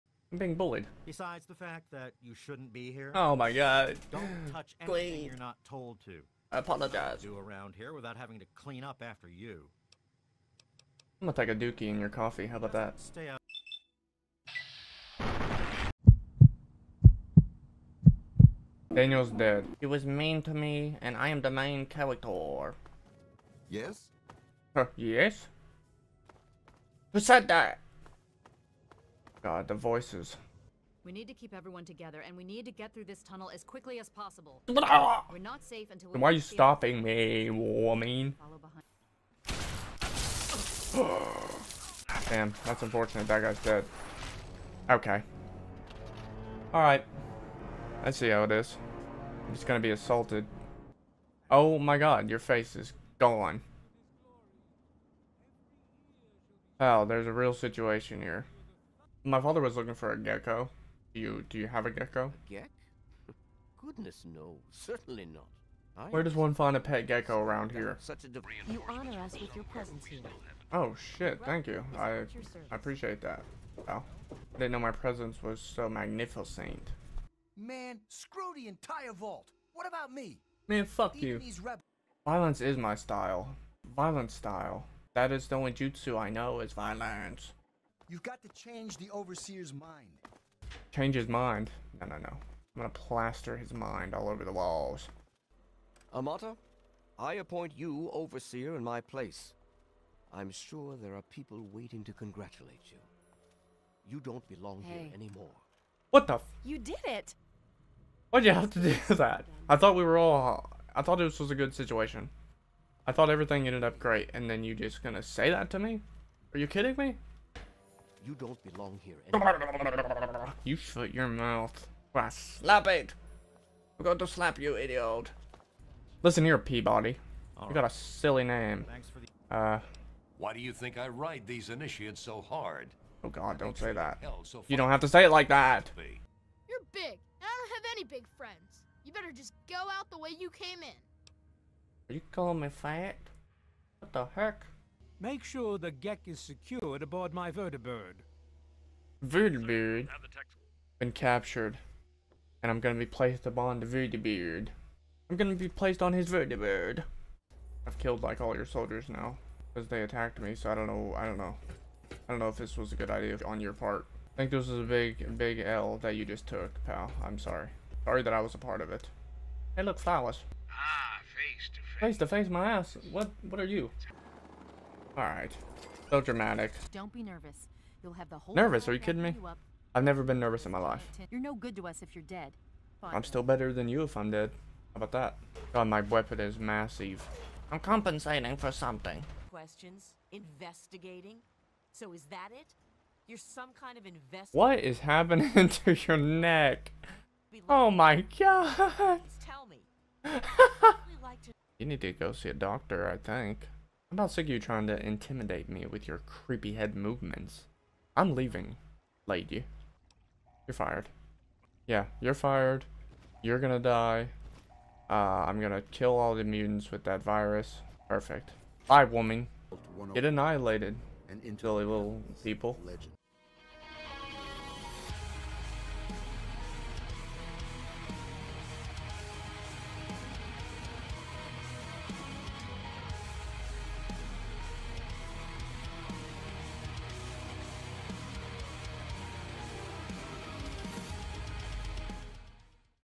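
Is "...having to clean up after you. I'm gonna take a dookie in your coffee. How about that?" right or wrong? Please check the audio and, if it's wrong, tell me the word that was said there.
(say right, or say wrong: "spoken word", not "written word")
right.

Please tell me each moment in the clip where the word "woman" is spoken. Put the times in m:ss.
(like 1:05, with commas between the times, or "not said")
0:37, 3:39.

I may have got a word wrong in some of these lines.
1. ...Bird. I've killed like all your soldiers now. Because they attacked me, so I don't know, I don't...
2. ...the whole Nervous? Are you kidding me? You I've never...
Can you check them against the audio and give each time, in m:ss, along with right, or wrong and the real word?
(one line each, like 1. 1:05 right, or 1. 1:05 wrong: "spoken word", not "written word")
1. 2:36 right
2. 2:58 right.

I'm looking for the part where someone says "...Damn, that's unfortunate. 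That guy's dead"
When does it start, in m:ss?
0:42.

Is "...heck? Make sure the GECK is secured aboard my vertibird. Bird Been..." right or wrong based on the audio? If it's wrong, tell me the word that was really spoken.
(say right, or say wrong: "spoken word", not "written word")
right.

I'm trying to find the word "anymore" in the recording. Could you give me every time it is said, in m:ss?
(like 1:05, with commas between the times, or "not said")
1:45, 1:59.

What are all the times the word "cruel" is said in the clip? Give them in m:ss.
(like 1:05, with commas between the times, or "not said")
not said.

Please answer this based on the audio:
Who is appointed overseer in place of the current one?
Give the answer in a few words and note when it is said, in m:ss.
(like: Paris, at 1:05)
Amata, at 1:36.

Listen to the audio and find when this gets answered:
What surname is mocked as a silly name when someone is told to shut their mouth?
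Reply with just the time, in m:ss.
2:06.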